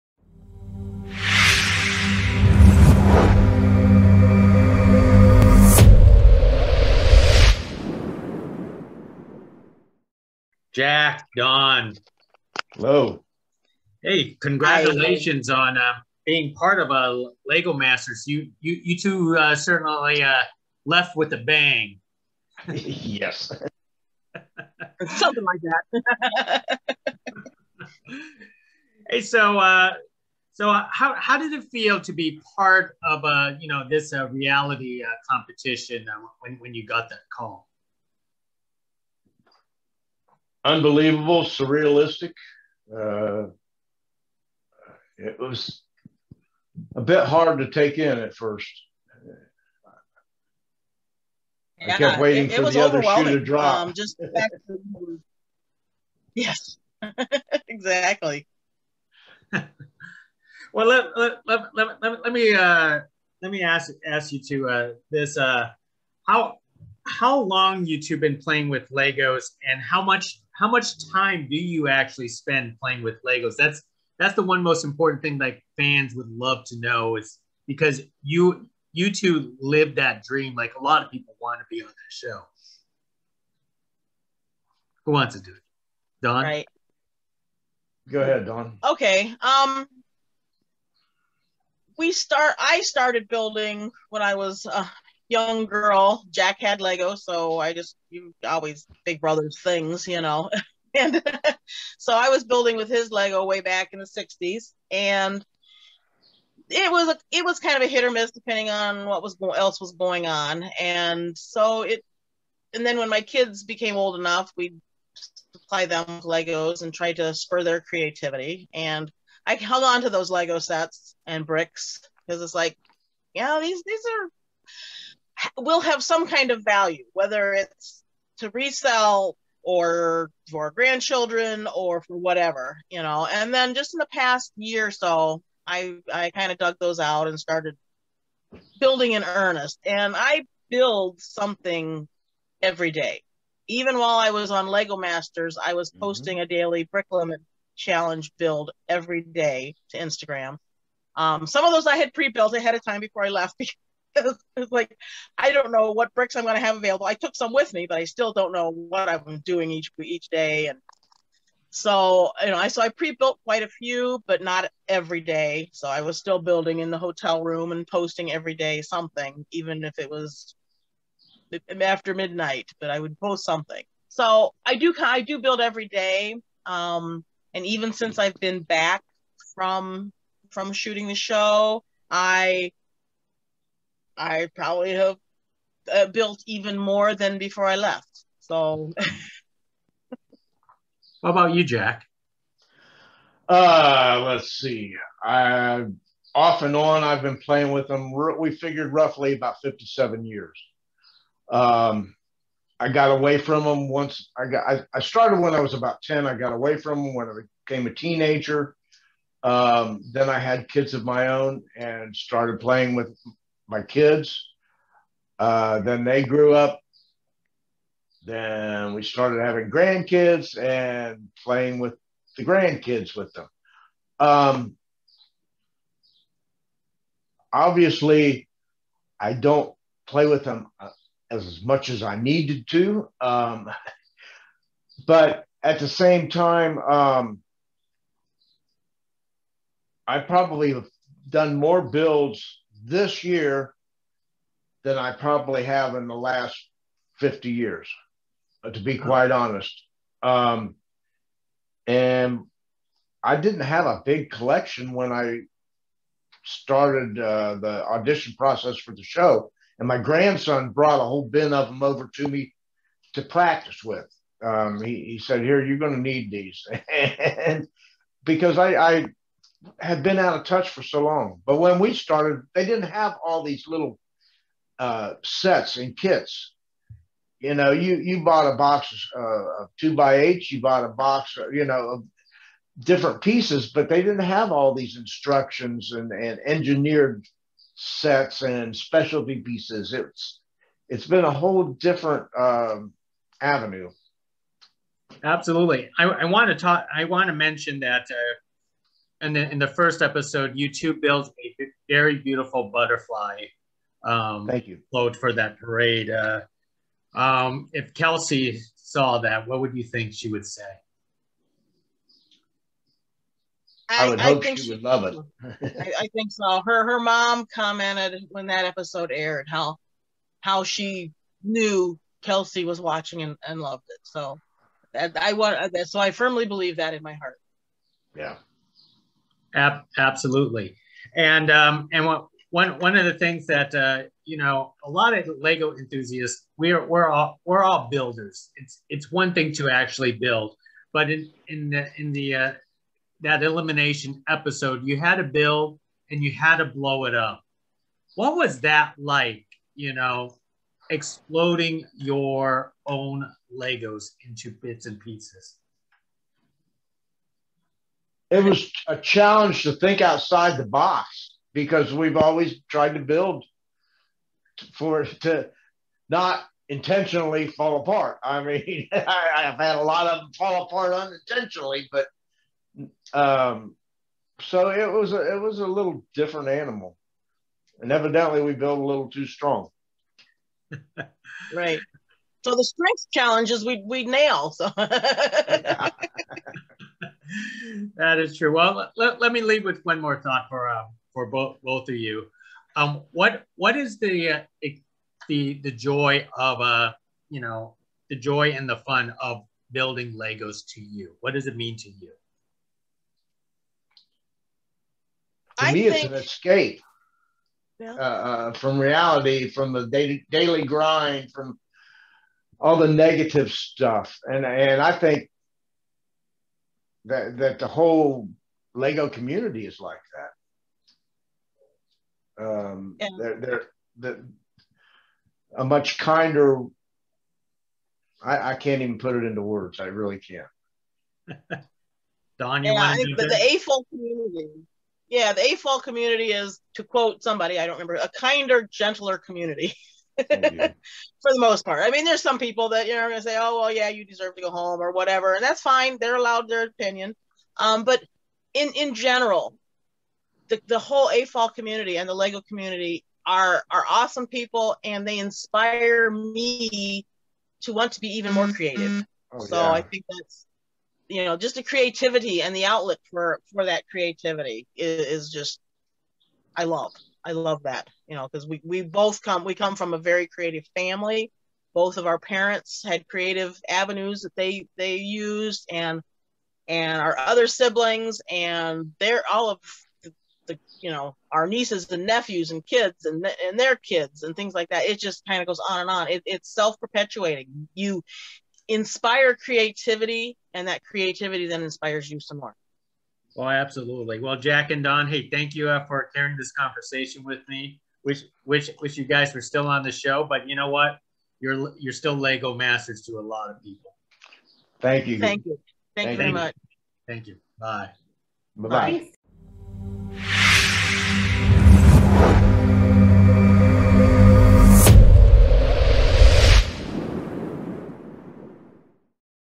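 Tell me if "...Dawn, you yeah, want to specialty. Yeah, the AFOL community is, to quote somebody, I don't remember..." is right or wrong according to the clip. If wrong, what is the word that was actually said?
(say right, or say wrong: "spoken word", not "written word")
wrong: "community", not "specialty".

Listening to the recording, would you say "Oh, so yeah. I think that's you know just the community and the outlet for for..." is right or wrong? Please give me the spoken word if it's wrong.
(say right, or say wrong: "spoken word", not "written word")
wrong: "creativity", not "community".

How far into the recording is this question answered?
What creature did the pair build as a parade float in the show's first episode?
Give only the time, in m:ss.
5:02.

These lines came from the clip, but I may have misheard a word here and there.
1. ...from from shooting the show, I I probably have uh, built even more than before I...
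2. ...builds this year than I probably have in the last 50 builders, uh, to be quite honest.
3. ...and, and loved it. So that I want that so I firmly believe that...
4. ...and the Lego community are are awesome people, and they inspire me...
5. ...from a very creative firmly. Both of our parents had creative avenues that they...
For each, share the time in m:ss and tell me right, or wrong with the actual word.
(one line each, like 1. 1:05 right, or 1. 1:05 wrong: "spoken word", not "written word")
1. 2:59 right
2. 4:01 wrong: "years", not "builders"
3. 5:23 right
4. 7:31 right
5. 7:49 wrong: "family", not "firmly".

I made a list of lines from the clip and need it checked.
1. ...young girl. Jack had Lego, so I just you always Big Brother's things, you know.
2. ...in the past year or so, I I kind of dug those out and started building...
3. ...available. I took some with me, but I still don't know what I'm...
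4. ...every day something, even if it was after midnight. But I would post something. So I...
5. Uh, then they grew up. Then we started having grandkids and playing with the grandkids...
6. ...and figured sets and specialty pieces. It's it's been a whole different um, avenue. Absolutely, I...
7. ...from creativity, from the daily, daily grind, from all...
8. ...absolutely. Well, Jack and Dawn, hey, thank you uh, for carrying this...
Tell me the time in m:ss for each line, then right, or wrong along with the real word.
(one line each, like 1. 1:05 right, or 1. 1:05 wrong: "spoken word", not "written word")
1. 1:35 right
2. 2:13 right
3. 2:36 right
4. 2:48 right
5. 3:35 right
6. 4:46 wrong: "engineered", not "figured"
7. 6:48 wrong: "reality", not "creativity"
8. 8:13 right.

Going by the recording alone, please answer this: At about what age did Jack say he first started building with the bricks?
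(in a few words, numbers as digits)
10.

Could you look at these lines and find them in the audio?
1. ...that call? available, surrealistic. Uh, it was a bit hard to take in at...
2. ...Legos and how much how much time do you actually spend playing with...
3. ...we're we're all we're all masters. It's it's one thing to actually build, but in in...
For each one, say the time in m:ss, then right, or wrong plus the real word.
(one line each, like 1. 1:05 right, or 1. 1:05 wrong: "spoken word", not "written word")
1. 0:37 wrong: "unbelievable", not "available"
2. 1:08 right
3. 5:36 wrong: "builders", not "masters".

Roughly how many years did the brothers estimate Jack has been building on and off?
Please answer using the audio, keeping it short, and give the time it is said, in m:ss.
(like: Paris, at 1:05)
57, at 3:19.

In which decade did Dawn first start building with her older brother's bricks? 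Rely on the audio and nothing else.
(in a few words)
1960s.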